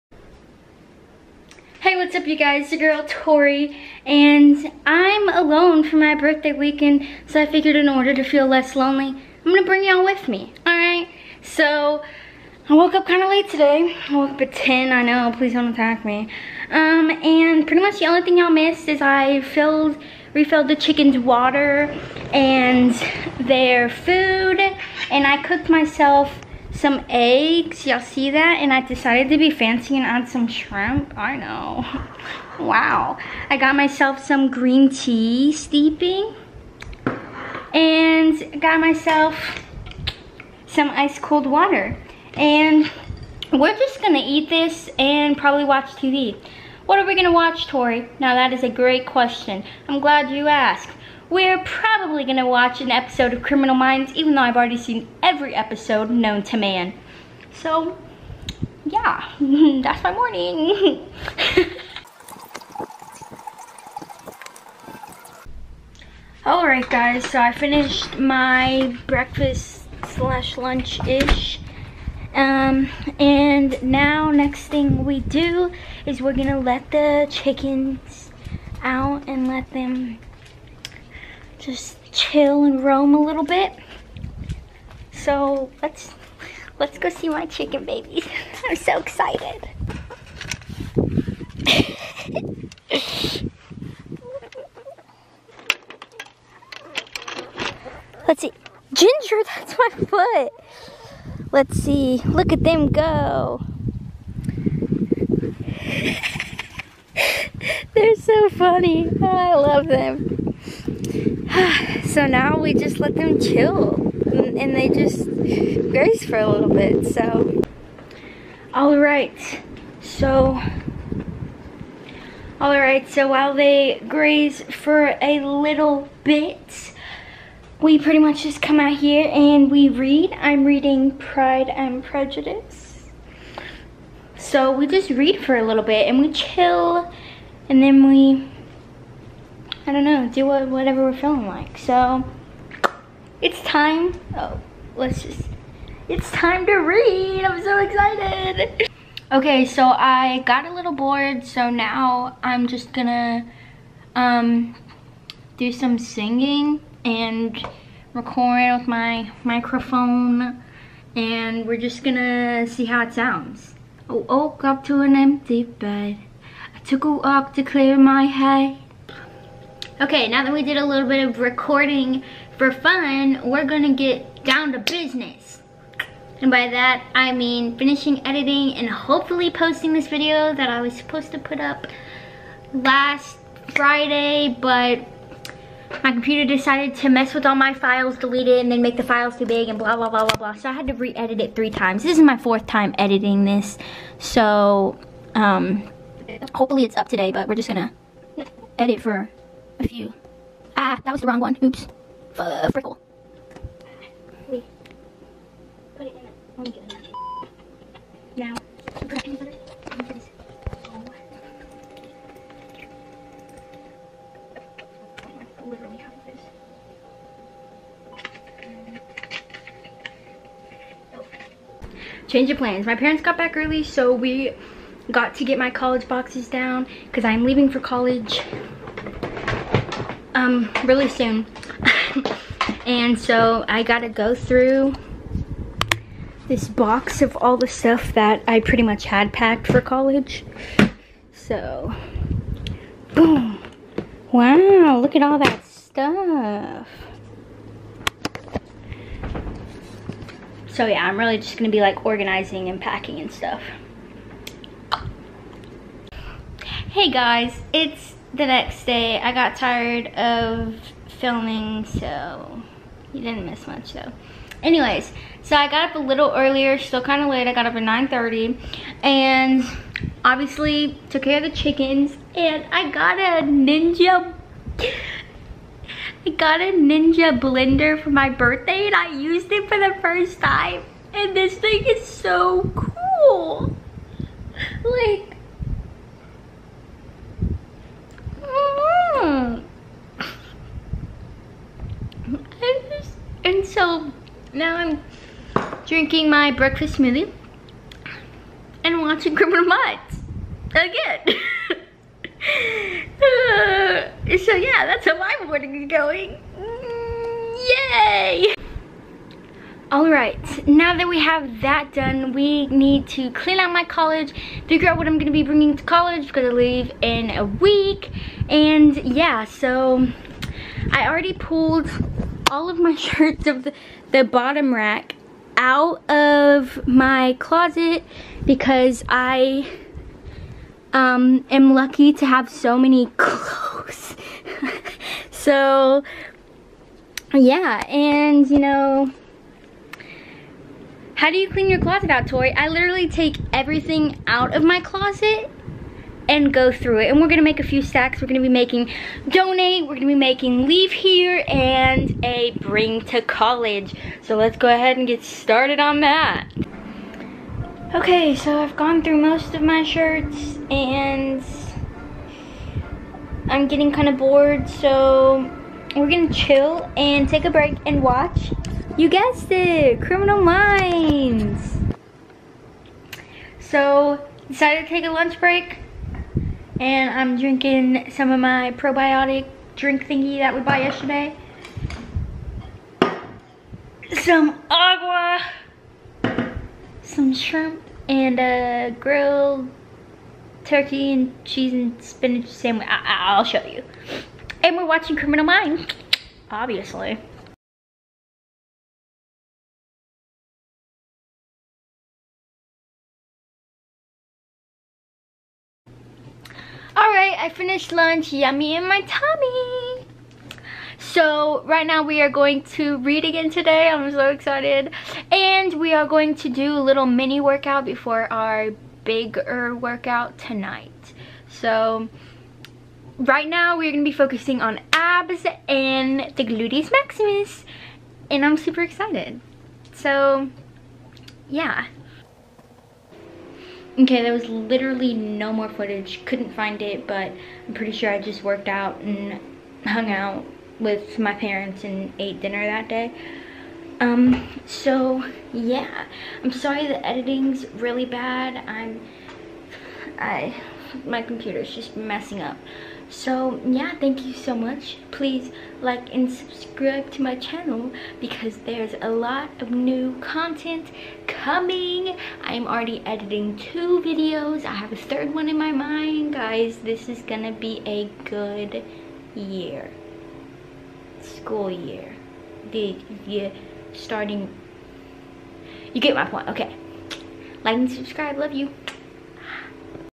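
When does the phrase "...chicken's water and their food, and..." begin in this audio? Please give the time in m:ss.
0:20.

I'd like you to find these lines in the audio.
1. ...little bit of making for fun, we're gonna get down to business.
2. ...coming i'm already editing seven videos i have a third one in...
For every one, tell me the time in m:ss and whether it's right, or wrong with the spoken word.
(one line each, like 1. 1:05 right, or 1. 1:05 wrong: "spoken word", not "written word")
1. 2:50 wrong: "recording", not "making"
2. 7:41 wrong: "two", not "seven".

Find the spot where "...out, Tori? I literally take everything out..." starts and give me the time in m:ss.
5:42.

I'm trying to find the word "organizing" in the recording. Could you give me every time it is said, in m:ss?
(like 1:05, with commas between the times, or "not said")
4:12.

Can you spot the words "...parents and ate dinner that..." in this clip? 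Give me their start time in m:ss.
7:21.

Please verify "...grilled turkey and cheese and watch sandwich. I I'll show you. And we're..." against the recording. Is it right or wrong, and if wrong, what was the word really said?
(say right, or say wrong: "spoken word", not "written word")
wrong: "spinach", not "watch".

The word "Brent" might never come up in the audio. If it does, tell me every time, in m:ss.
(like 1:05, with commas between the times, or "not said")
not said.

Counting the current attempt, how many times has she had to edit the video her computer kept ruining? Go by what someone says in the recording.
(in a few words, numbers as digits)
4.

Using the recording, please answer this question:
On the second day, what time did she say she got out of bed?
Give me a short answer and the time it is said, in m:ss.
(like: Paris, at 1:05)
9:30, at 4:27.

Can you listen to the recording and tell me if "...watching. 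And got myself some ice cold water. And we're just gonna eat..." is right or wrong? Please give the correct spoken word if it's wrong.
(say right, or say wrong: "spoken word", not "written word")
wrong: "steeping", not "watching".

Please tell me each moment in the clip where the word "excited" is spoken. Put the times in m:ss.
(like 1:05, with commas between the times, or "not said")
1:28, 2:27, 6:54, 7:08.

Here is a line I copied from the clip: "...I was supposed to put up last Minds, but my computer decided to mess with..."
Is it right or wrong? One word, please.
wrong.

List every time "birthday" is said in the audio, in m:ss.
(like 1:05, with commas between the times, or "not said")
0:06, 4:38.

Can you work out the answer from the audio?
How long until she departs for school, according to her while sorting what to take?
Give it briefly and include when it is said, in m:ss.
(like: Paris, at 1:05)
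a week, at 5:17.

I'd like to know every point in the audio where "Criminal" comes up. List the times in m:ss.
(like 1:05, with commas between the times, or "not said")
0:53, 4:59, 6:10, 6:35.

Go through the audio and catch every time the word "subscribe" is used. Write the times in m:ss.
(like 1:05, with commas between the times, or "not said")
7:36, 7:57.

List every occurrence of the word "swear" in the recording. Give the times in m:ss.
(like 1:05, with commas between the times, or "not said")
not said.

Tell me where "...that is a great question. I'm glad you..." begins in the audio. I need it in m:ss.
0:48.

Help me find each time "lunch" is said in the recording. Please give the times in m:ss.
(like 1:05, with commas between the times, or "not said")
1:10, 6:15, 6:47.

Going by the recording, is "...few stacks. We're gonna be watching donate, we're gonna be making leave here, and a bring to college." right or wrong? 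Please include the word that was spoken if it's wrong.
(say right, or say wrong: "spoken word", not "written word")
wrong: "making", not "watching".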